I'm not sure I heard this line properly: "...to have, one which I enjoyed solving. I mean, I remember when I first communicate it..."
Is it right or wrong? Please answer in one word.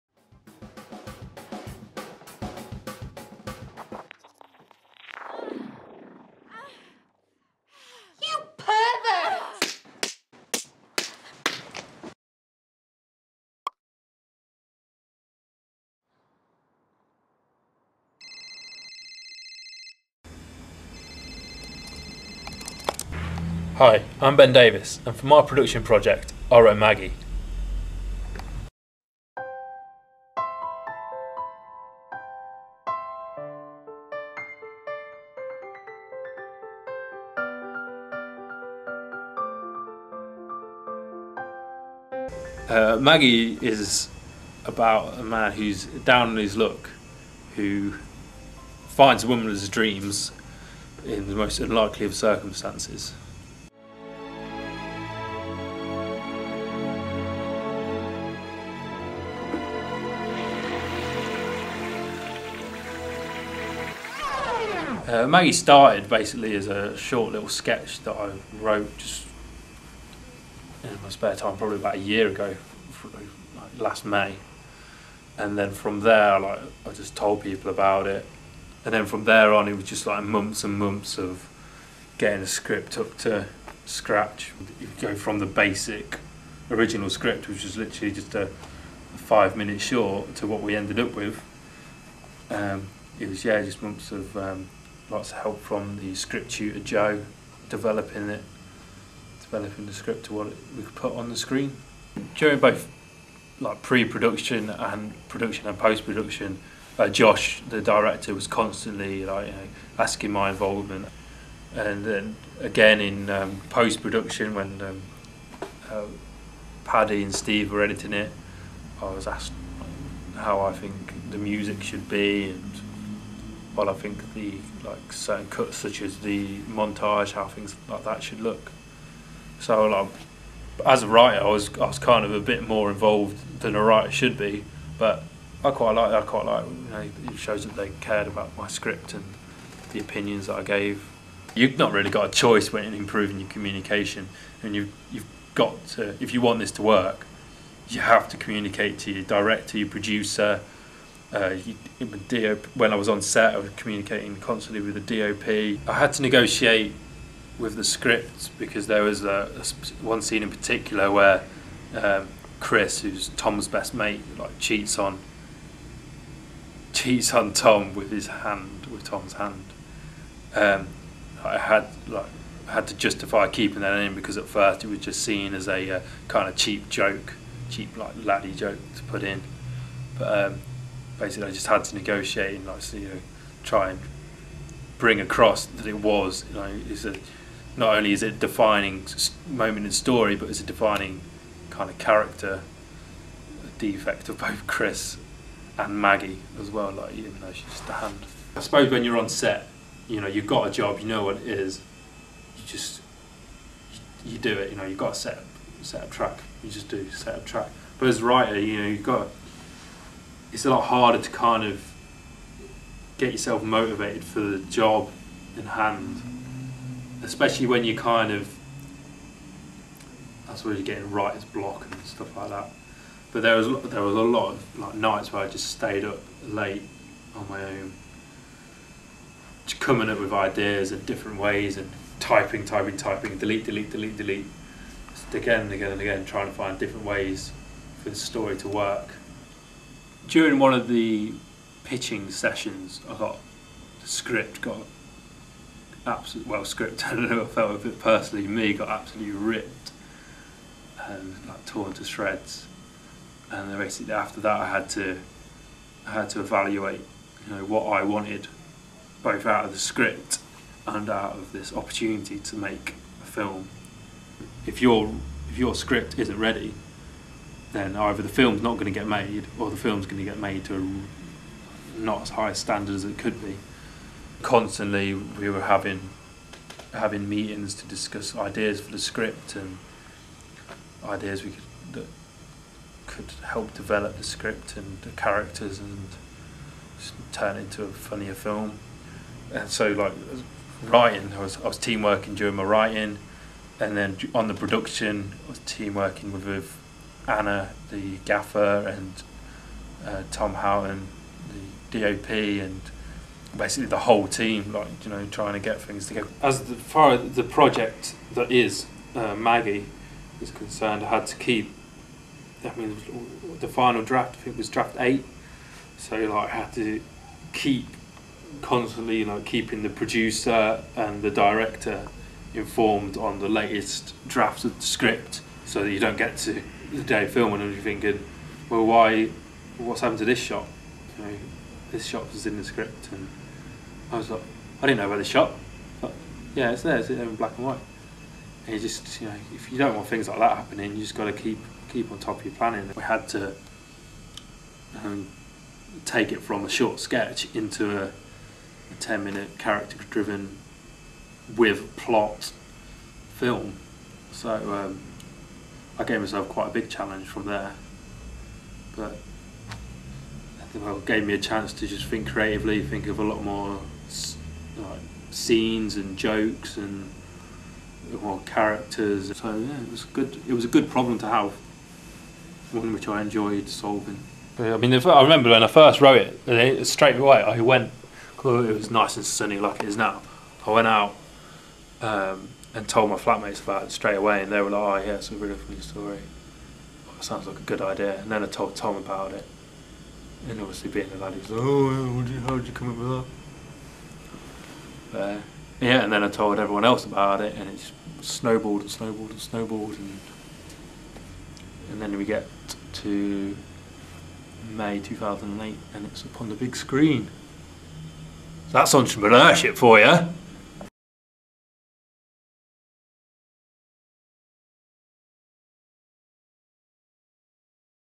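wrong.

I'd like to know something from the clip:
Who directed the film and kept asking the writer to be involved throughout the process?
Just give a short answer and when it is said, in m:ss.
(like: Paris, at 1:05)
Josh, at 1:47.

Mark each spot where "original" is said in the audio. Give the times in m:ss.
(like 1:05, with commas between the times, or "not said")
1:26.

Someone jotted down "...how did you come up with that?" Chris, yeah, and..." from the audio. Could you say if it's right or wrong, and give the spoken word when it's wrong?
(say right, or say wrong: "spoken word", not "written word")
wrong: "But", not "Chris".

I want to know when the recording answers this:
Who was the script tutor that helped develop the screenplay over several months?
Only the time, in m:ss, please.
1:36.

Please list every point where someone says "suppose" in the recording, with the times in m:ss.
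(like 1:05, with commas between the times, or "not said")
3:18, 3:40.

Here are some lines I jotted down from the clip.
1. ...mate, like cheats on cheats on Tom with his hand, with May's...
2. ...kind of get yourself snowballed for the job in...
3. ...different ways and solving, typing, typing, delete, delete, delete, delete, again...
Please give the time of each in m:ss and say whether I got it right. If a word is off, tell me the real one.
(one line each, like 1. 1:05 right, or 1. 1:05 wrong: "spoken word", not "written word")
1. 2:43 wrong: "Tom", not "May"
2. 3:31 wrong: "motivated", not "snowballed"
3. 3:51 wrong: "typing", not "solving".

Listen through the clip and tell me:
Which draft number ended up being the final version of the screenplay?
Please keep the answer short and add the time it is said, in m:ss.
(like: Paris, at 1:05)
8, at 5:14.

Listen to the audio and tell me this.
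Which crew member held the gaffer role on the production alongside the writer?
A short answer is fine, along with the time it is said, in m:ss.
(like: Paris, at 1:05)
Anna, at 4:57.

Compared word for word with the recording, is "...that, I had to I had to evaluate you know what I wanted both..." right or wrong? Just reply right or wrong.
right.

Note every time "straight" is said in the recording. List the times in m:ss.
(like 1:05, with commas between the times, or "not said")
6:16, 6:23.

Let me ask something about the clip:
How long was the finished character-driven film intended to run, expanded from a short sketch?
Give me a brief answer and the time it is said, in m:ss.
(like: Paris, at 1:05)
10 minutes, at 5:48.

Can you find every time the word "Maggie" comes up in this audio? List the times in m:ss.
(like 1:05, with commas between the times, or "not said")
0:26, 0:42, 1:05, 3:16, 5:09.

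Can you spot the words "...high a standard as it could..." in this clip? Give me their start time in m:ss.
4:32.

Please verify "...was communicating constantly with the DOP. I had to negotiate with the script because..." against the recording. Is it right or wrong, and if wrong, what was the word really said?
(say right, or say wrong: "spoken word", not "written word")
right.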